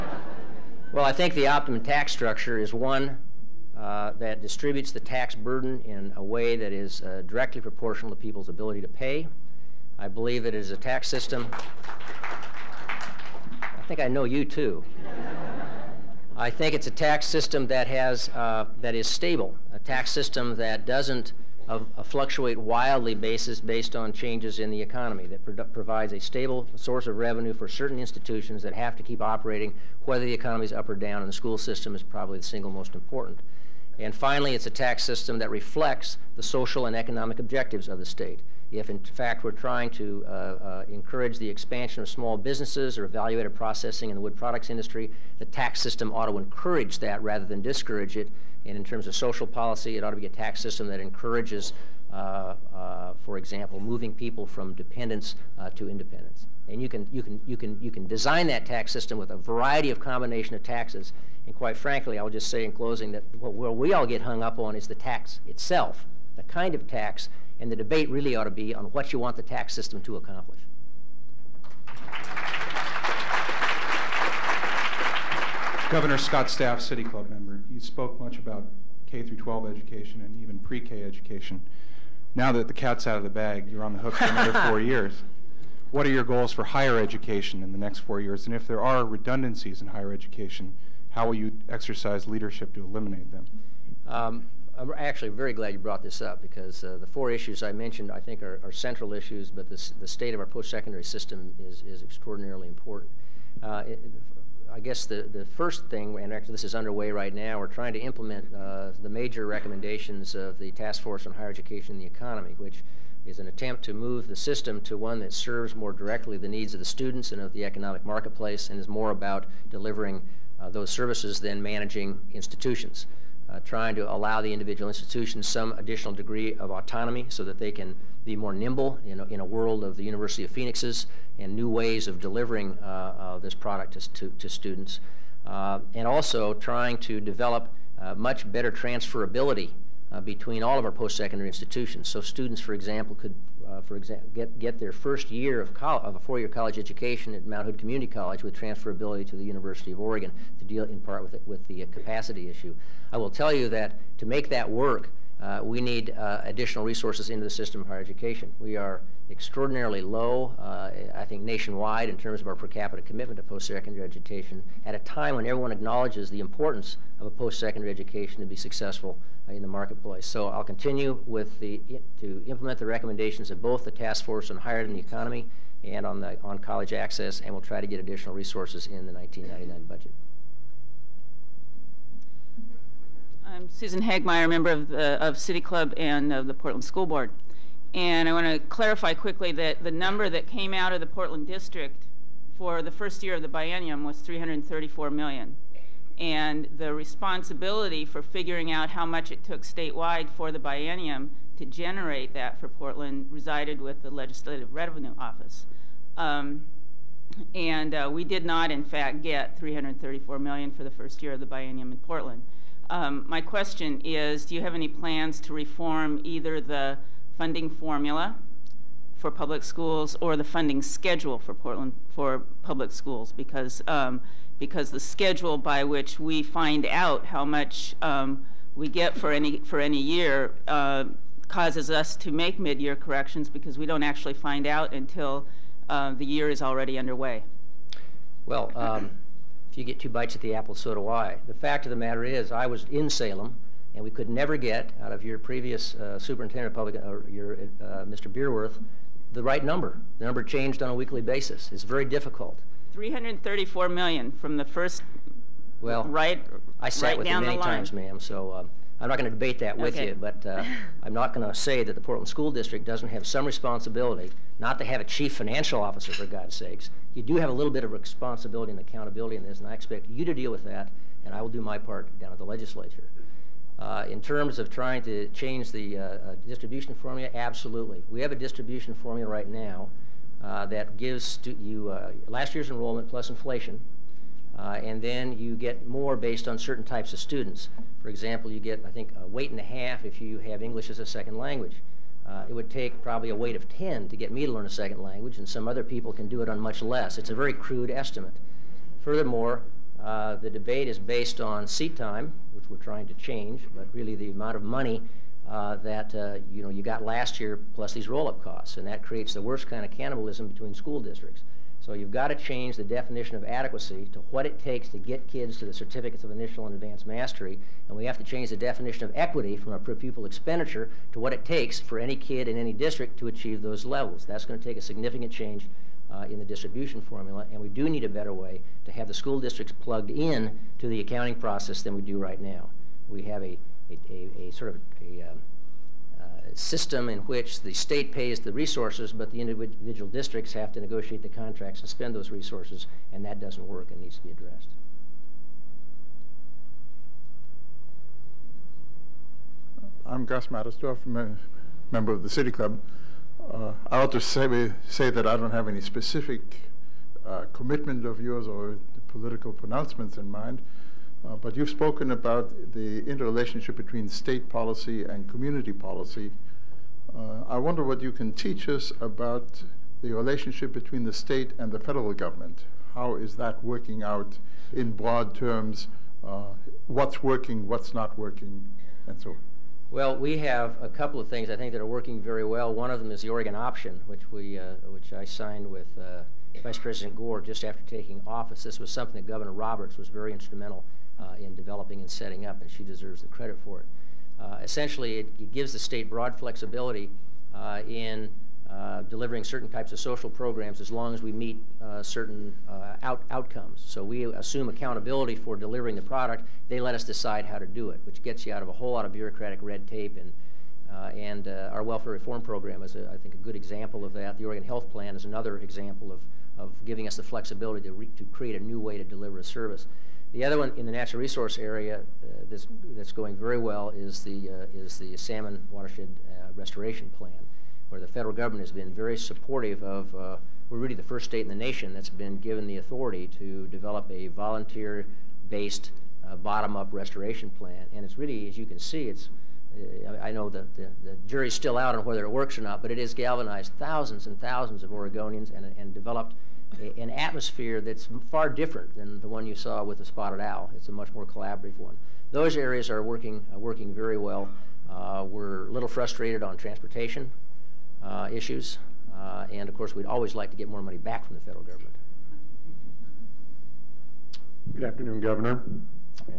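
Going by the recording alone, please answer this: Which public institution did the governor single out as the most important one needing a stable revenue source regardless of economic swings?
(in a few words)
the school system.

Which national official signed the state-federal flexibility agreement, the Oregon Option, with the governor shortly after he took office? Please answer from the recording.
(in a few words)
Vice President Gore.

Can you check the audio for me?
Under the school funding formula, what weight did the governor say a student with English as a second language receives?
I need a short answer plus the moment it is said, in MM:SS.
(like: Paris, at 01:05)
a weight and a half, at 04:49.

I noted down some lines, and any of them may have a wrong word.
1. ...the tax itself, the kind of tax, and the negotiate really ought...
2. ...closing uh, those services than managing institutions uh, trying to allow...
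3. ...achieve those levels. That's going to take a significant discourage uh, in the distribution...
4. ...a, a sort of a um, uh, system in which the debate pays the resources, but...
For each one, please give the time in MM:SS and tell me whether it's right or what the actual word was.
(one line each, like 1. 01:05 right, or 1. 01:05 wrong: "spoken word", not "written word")
1. 01:04 wrong: "debate", not "negotiate"
2. 01:59 wrong: "delivering", not "closing"
3. 05:23 wrong: "change", not "discourage"
4. 05:34 wrong: "state", not "debate".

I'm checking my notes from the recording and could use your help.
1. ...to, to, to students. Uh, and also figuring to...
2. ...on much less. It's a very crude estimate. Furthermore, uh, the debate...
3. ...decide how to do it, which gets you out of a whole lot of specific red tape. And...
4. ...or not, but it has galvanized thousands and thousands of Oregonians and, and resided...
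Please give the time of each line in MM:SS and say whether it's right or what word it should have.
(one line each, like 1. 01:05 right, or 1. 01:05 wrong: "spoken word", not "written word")
1. 02:13 wrong: "trying", not "figuring"
2. 04:56 right
3. 06:47 wrong: "bureaucratic", not "specific"
4. 07:22 wrong: "developed", not "resided".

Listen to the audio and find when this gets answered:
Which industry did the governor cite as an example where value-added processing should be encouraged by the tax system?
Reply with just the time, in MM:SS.
00:44.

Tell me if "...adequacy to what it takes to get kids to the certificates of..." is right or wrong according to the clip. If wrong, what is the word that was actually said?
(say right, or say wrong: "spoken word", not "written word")
right.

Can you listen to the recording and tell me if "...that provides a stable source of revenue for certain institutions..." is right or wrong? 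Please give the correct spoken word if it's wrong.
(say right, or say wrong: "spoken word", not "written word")
right.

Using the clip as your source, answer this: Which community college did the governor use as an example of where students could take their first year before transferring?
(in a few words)
Mount Hood Community College.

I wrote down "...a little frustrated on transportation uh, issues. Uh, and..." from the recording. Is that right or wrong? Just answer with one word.
right.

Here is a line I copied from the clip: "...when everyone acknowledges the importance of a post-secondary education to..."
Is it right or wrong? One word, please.
right.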